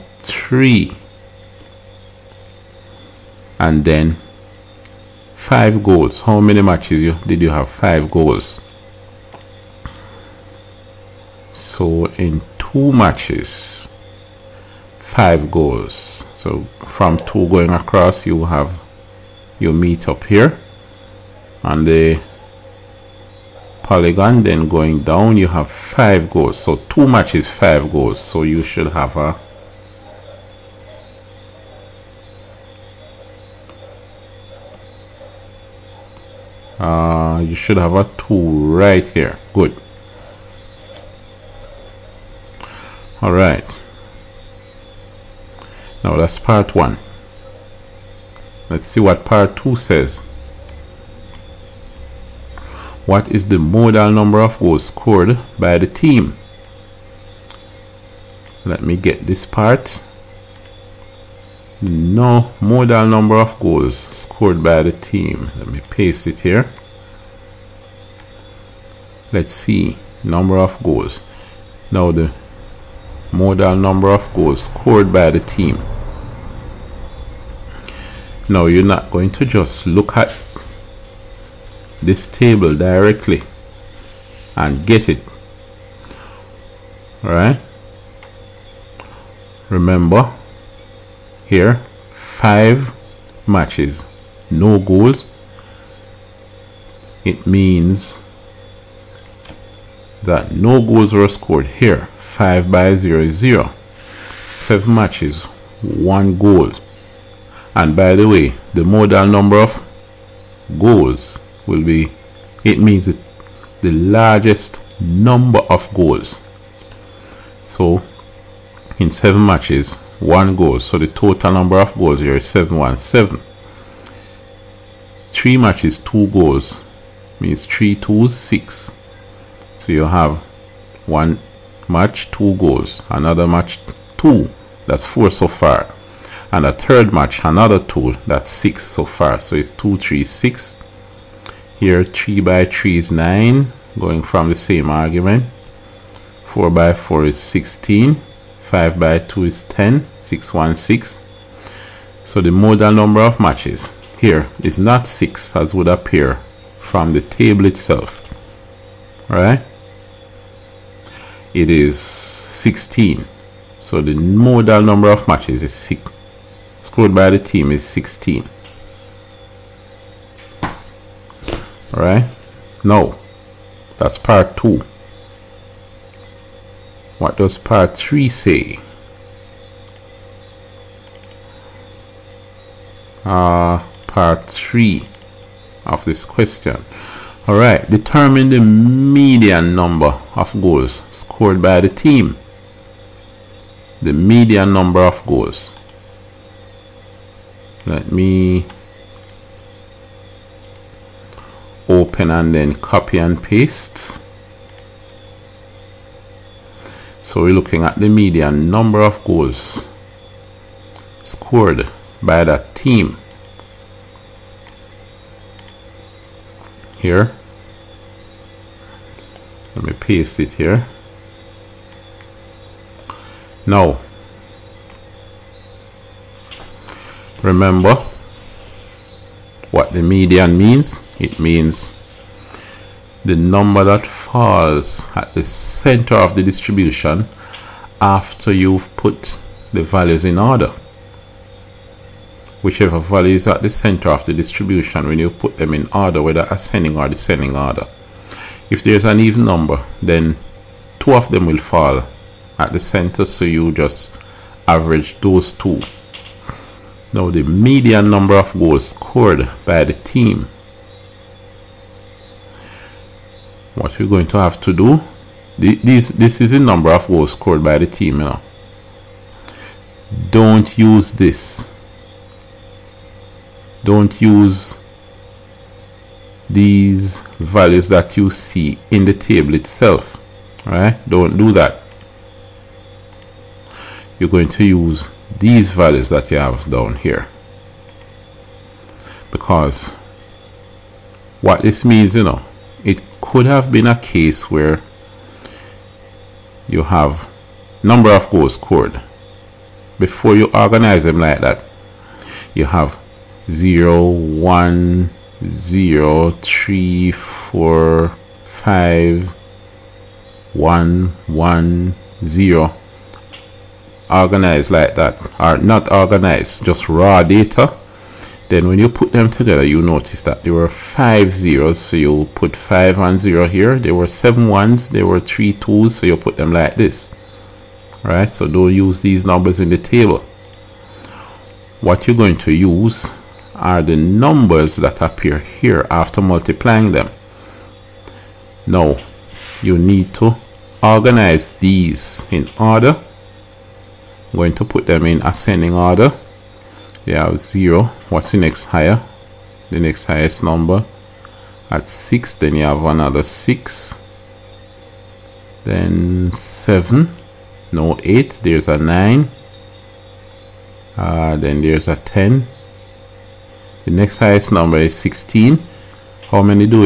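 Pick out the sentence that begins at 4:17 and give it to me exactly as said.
Now the median number of goals scored by the team.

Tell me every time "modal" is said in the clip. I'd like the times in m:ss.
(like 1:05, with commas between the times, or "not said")
0:53, 1:02, 1:13, 1:48, 2:32, 2:44.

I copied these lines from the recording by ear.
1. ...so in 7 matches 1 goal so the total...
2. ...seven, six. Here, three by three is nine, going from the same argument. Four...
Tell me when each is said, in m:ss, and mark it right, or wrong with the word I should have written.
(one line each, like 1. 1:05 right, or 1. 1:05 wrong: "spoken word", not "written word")
1. 1:57 right
2. 2:19 wrong: "three", not "seven".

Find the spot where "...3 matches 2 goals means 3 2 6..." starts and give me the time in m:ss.
2:05.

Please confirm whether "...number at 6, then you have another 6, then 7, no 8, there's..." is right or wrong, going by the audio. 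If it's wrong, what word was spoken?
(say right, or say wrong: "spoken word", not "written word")
right.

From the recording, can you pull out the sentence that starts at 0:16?
So from two going across, you have your meet up here on the polygon.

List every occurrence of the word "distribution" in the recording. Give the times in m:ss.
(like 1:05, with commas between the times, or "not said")
3:56, 4:04.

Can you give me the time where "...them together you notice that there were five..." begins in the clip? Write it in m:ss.
5:19.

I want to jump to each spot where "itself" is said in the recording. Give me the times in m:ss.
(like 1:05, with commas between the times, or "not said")
2:37, 4:39.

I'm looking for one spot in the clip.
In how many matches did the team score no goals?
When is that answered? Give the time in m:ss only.
1:32.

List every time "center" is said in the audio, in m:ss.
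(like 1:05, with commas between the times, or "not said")
3:55, 4:03, 4:12.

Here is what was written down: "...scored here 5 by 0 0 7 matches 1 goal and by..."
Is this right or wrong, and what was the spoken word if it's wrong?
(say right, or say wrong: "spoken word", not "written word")
right.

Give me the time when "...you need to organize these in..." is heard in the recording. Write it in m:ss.
5:39.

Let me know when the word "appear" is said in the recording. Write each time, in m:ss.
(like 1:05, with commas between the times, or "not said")
2:35, 5:35.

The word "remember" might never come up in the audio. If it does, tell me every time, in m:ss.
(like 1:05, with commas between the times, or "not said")
1:29, 3:47.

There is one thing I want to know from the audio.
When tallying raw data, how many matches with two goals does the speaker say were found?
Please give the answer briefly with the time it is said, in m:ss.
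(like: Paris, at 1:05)
3, at 5:25.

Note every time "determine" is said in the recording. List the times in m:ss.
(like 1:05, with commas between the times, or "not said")
3:07.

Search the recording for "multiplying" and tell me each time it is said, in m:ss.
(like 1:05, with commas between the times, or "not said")
5:36.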